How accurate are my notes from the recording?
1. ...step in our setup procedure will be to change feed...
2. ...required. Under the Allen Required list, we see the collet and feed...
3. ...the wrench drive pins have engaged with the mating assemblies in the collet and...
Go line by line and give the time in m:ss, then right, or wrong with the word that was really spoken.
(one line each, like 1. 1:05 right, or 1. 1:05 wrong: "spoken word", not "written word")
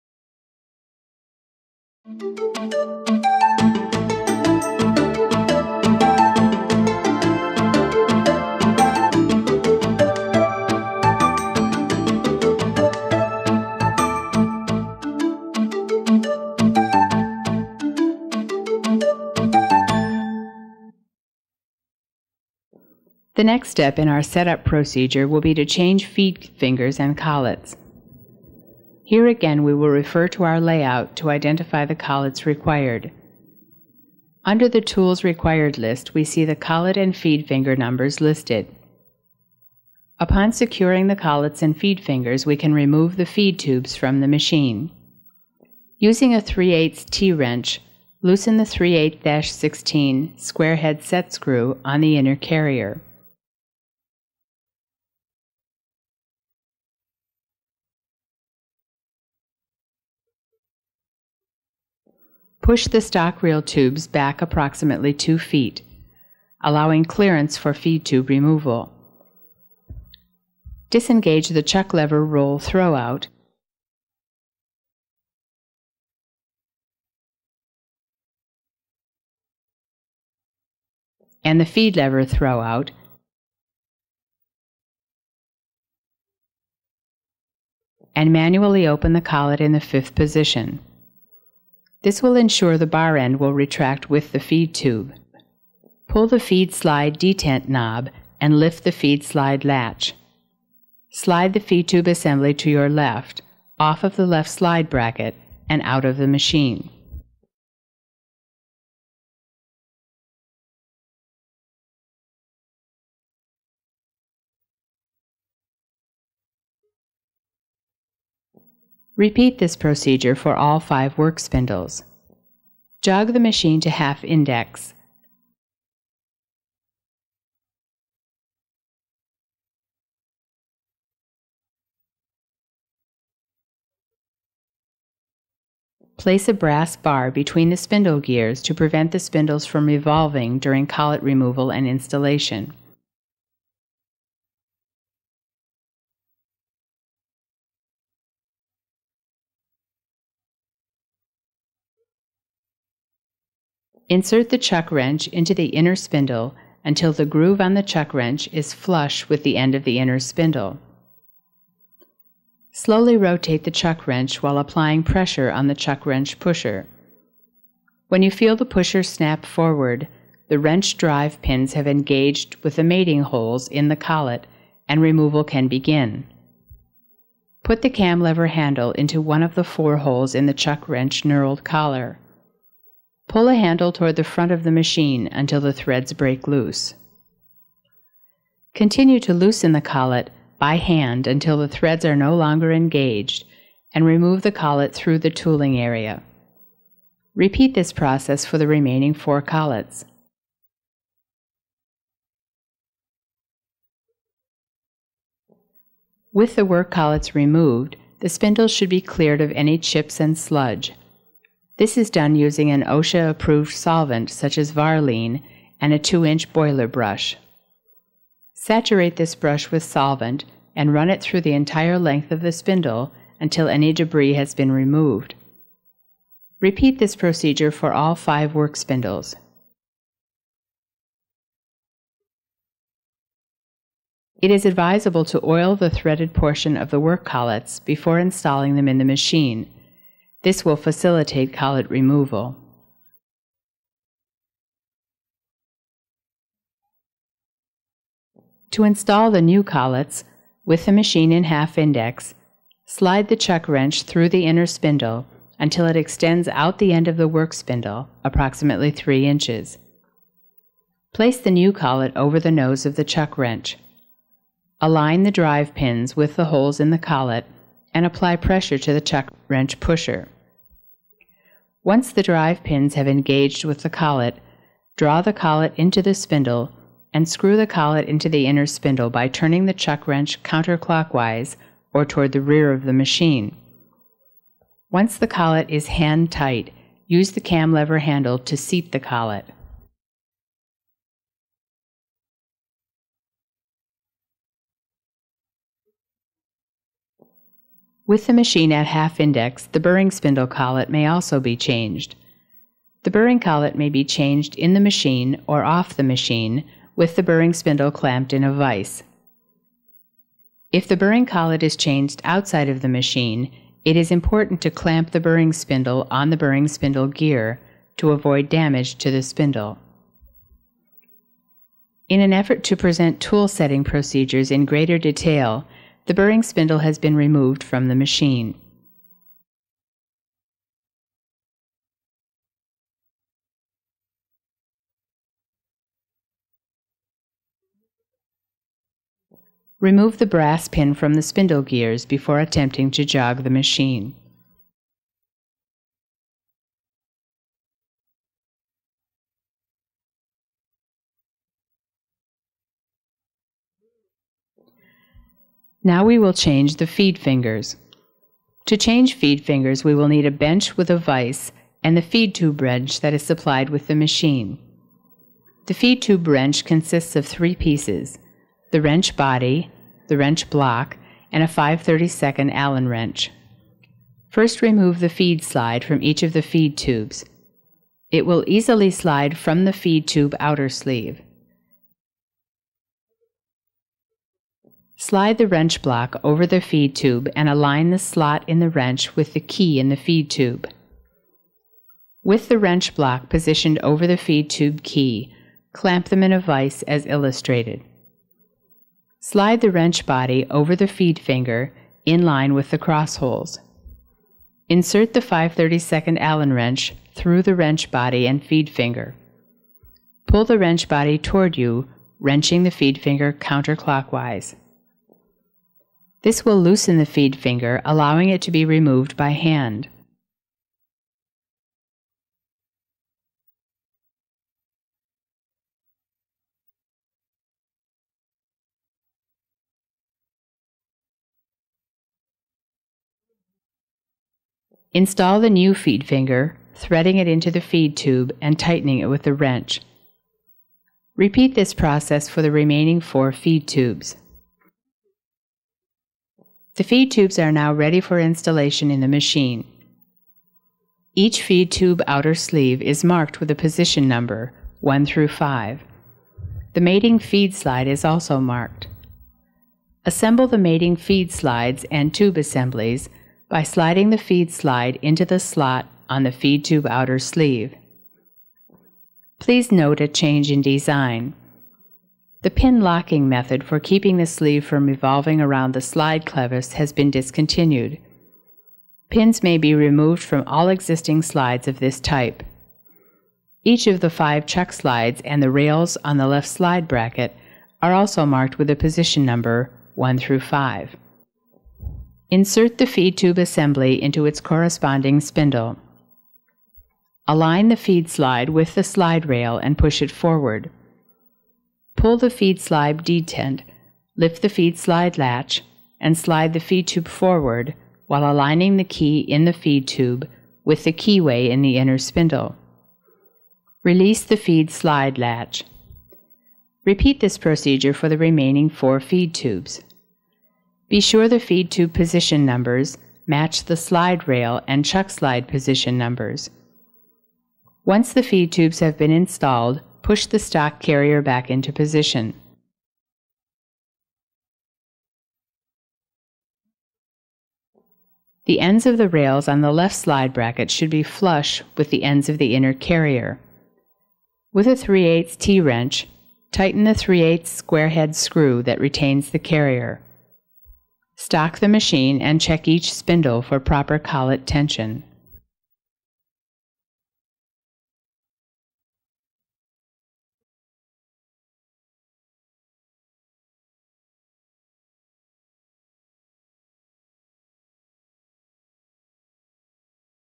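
1. 0:23 right
2. 0:32 wrong: "Tools", not "Allen"
3. 2:50 wrong: "holes", not "assemblies".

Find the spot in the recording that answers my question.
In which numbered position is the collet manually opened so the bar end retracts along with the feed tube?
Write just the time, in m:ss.
1:29.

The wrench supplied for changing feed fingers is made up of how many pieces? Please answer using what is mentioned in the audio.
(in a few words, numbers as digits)
3.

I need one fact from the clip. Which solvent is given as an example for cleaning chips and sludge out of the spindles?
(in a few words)
Varline.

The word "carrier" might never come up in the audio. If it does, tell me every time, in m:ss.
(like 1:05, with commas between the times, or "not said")
0:52, 8:50, 9:02, 9:09.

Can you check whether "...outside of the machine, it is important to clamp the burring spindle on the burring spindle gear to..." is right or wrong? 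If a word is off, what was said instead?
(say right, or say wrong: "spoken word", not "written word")
right.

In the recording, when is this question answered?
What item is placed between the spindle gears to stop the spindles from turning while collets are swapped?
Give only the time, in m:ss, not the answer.
2:16.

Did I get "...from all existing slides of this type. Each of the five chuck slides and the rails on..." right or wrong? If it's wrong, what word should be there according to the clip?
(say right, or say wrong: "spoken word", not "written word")
right.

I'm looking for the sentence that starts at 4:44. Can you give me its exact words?
Once the collet is hand tight, use the cam lever handle to seat the collet.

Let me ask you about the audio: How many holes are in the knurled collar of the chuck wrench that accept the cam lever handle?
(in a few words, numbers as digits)
4.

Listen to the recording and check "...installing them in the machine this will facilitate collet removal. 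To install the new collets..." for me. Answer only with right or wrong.
right.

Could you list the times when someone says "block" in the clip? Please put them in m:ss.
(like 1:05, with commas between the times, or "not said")
6:10, 6:25, 6:32.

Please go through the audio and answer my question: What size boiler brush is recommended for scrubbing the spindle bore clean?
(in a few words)
2 inch.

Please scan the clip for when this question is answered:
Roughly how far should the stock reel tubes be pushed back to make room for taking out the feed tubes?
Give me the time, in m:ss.
1:05.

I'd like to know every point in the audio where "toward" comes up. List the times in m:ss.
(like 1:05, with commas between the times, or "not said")
3:03, 4:42, 6:51.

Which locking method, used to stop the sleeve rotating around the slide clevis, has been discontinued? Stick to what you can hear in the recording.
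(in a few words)
pin locking.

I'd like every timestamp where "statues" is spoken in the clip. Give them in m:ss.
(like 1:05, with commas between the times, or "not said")
not said.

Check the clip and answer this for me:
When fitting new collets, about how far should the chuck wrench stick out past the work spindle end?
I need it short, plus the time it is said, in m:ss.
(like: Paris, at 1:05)
3 inches, at 4:18.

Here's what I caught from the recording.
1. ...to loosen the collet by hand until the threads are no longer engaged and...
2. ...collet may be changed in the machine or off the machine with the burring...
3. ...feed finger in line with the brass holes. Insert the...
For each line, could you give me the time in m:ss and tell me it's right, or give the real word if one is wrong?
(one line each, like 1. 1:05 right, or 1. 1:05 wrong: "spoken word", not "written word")
1. 3:09 right
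2. 5:03 right
3. 6:40 wrong: "cross", not "brass".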